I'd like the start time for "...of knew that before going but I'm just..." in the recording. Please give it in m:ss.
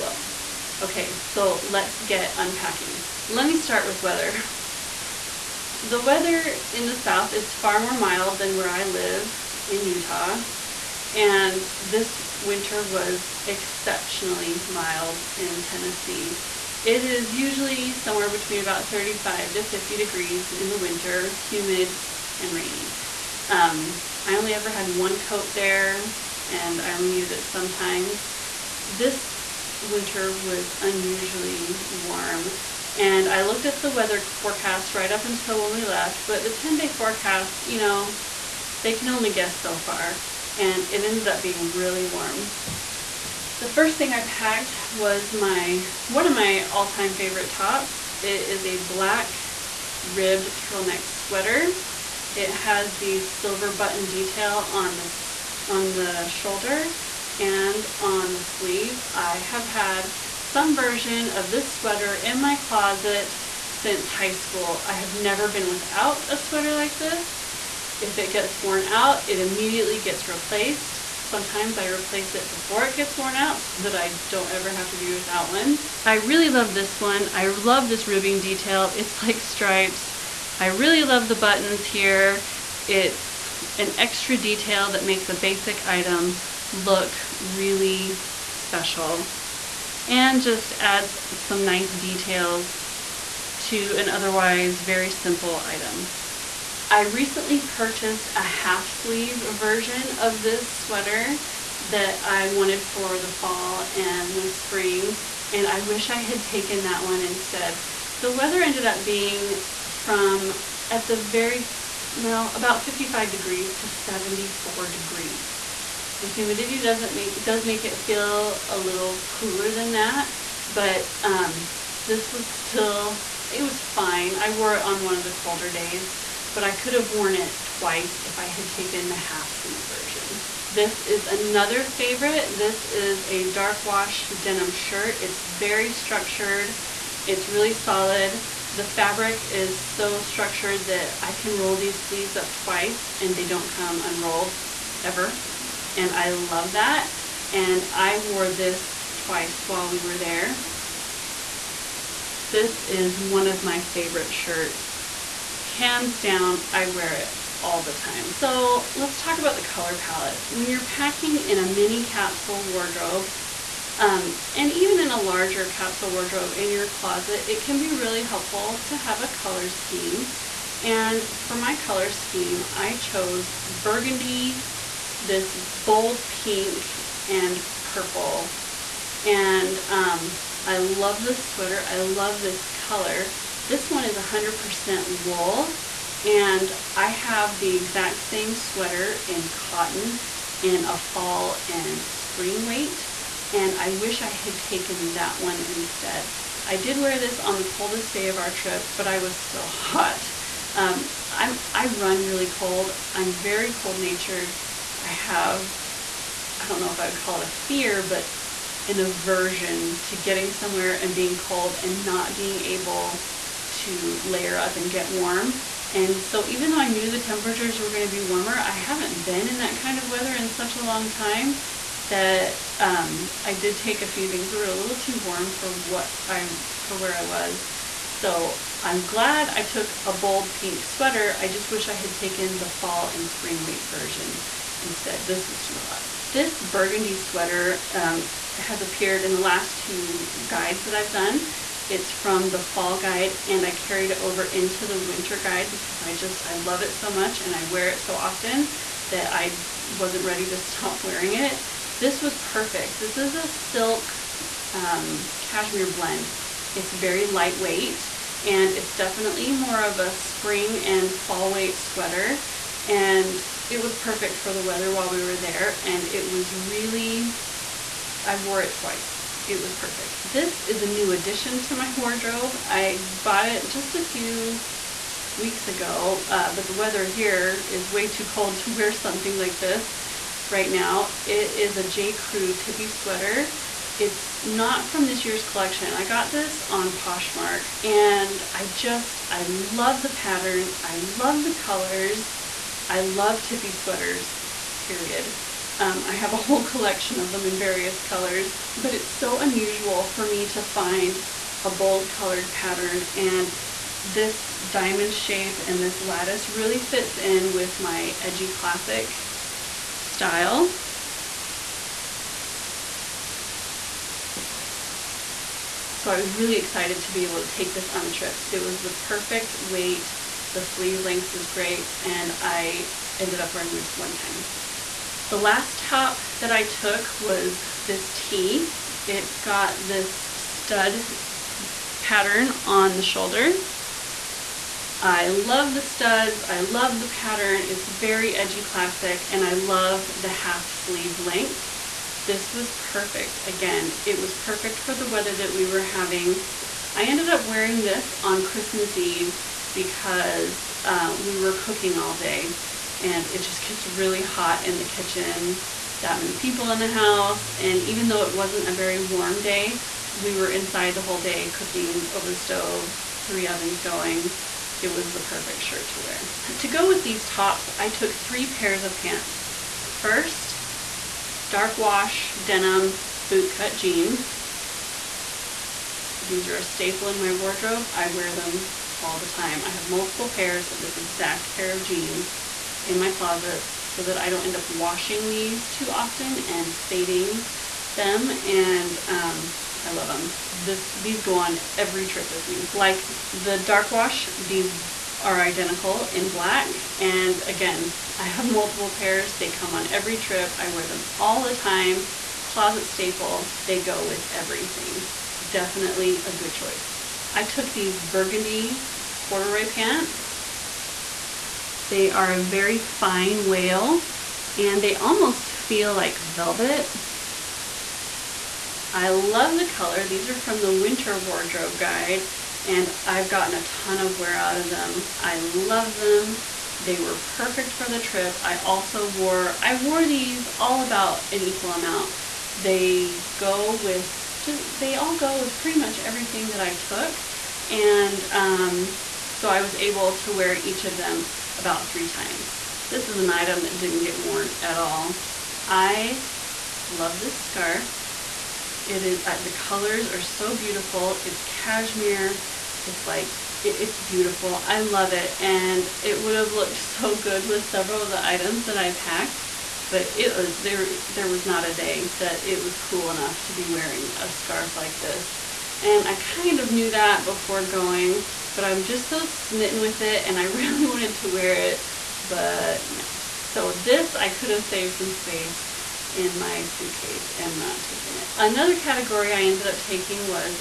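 7:46.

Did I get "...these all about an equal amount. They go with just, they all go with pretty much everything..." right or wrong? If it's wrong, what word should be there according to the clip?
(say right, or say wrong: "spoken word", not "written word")
right.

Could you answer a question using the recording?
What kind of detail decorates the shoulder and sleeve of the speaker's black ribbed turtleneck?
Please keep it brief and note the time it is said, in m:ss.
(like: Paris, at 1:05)
silver button, at 0:53.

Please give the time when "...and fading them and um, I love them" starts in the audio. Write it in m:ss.
6:26.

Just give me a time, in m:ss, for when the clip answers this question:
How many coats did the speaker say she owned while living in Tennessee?
0:24.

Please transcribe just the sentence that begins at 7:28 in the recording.
It is uh, the colors are so beautiful.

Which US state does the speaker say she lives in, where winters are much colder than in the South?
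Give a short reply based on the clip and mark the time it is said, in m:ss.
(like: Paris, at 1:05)
Utah, at 0:09.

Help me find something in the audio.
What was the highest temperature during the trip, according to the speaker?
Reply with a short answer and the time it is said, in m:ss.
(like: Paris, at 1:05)
74 degrees, at 1:53.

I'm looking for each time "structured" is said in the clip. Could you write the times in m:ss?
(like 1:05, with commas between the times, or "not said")
2:15, 2:20.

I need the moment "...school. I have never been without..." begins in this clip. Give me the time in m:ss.
1:04.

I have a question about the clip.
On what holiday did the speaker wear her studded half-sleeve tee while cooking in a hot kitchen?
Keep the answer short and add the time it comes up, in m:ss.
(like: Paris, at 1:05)
Christmas Eve, at 5:48.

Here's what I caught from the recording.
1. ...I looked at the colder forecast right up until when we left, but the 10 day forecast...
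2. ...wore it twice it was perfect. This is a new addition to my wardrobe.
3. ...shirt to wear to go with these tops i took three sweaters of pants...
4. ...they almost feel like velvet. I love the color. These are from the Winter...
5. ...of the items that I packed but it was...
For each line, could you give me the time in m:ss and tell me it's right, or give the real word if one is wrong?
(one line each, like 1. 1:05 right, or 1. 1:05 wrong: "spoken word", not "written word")
1. 0:33 wrong: "weather", not "colder"
2. 4:28 right
3. 6:05 wrong: "pairs", not "sweaters"
4. 6:54 right
5. 7:38 right.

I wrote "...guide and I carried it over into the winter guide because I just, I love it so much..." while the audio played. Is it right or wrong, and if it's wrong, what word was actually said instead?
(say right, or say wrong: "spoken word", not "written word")
right.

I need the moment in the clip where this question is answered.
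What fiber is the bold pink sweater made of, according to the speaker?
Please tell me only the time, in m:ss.
3:04.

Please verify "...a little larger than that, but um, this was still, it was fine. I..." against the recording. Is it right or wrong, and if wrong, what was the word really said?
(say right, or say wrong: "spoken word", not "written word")
wrong: "cooler", not "larger".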